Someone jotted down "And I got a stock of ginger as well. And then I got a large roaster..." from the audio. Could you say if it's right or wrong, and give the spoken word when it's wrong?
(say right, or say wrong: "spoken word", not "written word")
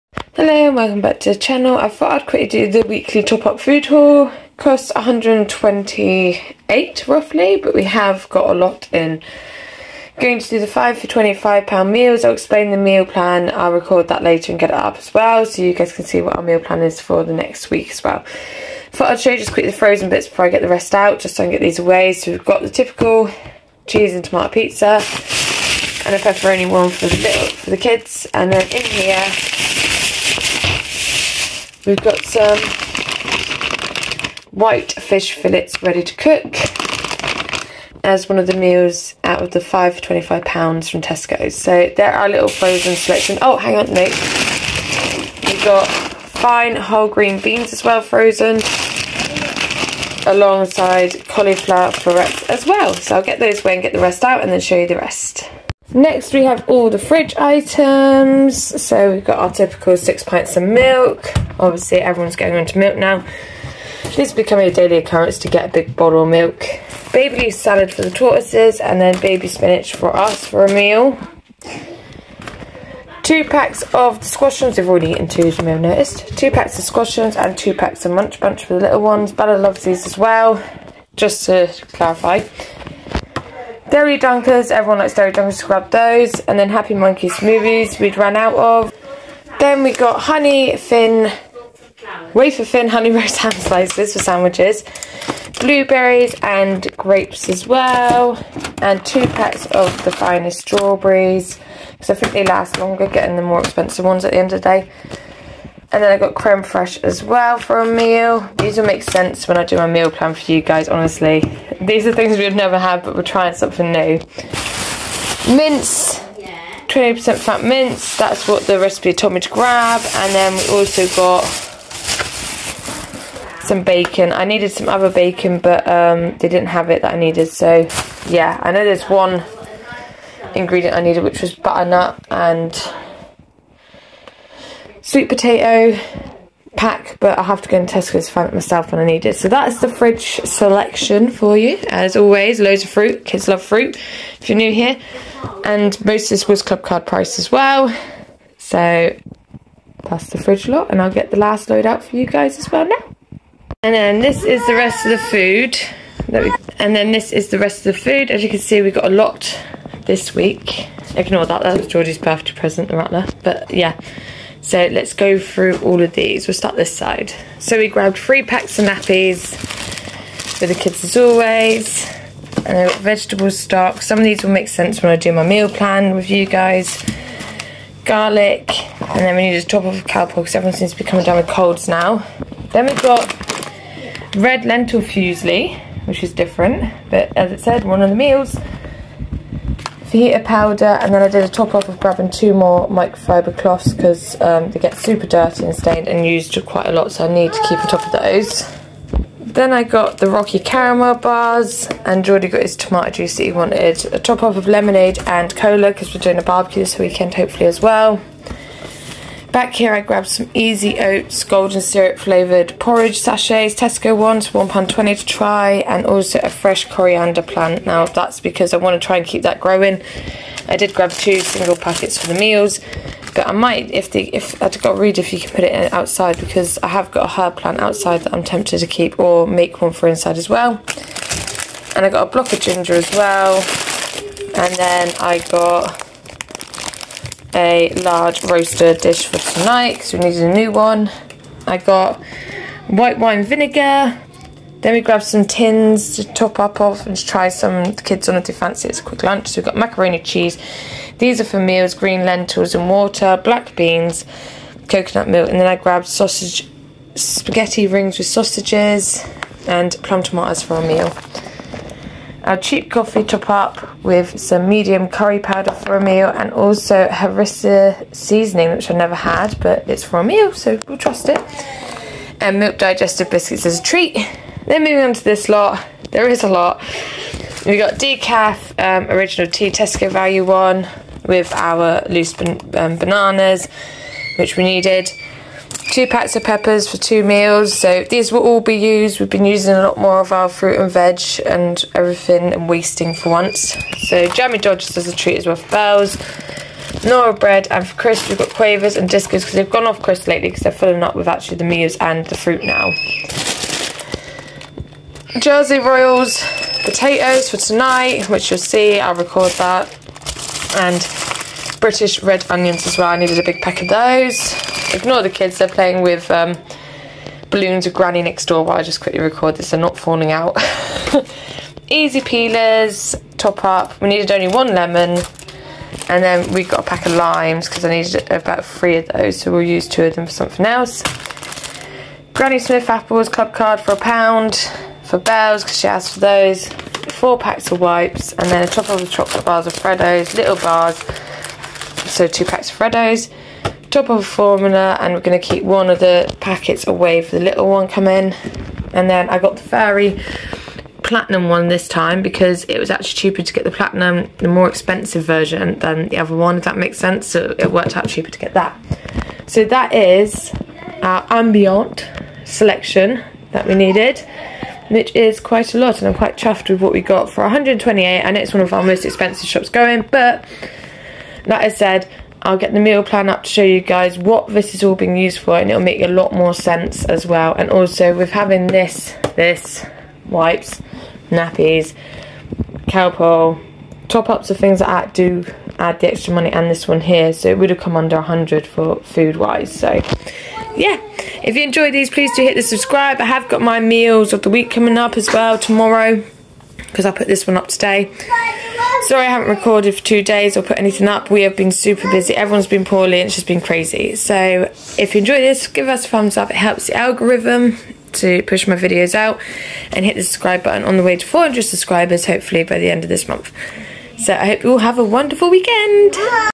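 wrong: "block", not "stock".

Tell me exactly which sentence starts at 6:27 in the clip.
So it would have come under 100 for food-wise.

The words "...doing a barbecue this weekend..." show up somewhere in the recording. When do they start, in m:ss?
3:26.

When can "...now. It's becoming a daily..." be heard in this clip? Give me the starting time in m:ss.
1:02.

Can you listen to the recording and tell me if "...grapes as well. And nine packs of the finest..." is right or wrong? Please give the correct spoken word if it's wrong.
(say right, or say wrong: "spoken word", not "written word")
wrong: "two", not "nine".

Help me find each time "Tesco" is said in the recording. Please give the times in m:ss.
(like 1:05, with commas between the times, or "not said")
0:41, 3:33, 4:39.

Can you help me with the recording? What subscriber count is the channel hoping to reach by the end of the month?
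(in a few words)
400.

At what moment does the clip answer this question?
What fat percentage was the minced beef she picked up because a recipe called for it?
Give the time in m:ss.
1:56.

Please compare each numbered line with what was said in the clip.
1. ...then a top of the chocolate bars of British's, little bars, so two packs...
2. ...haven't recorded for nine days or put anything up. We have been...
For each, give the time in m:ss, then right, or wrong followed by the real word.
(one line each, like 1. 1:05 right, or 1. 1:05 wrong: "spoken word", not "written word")
1. 5:38 wrong: "Freddo", not "British"
2. 6:39 wrong: "two", not "nine".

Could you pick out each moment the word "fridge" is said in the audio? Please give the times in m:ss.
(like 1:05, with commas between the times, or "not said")
0:56, 2:19, 2:30.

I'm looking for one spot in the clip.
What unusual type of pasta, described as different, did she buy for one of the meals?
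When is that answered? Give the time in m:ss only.
3:04.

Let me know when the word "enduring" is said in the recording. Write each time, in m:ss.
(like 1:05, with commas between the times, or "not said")
not said.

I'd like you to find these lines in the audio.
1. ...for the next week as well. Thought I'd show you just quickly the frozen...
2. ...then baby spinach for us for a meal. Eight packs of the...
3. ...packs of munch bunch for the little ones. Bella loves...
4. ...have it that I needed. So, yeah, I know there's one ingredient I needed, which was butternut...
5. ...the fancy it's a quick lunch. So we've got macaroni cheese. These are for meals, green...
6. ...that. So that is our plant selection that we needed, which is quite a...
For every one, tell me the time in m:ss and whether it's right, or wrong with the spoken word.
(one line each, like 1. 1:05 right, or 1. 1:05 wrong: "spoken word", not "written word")
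1. 0:16 right
2. 1:09 wrong: "Two", not "Eight"
3. 1:17 right
4. 2:06 right
5. 4:08 right
6. 5:58 wrong: "ambient", not "plant".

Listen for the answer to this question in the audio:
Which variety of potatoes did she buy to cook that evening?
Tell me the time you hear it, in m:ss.
5:05.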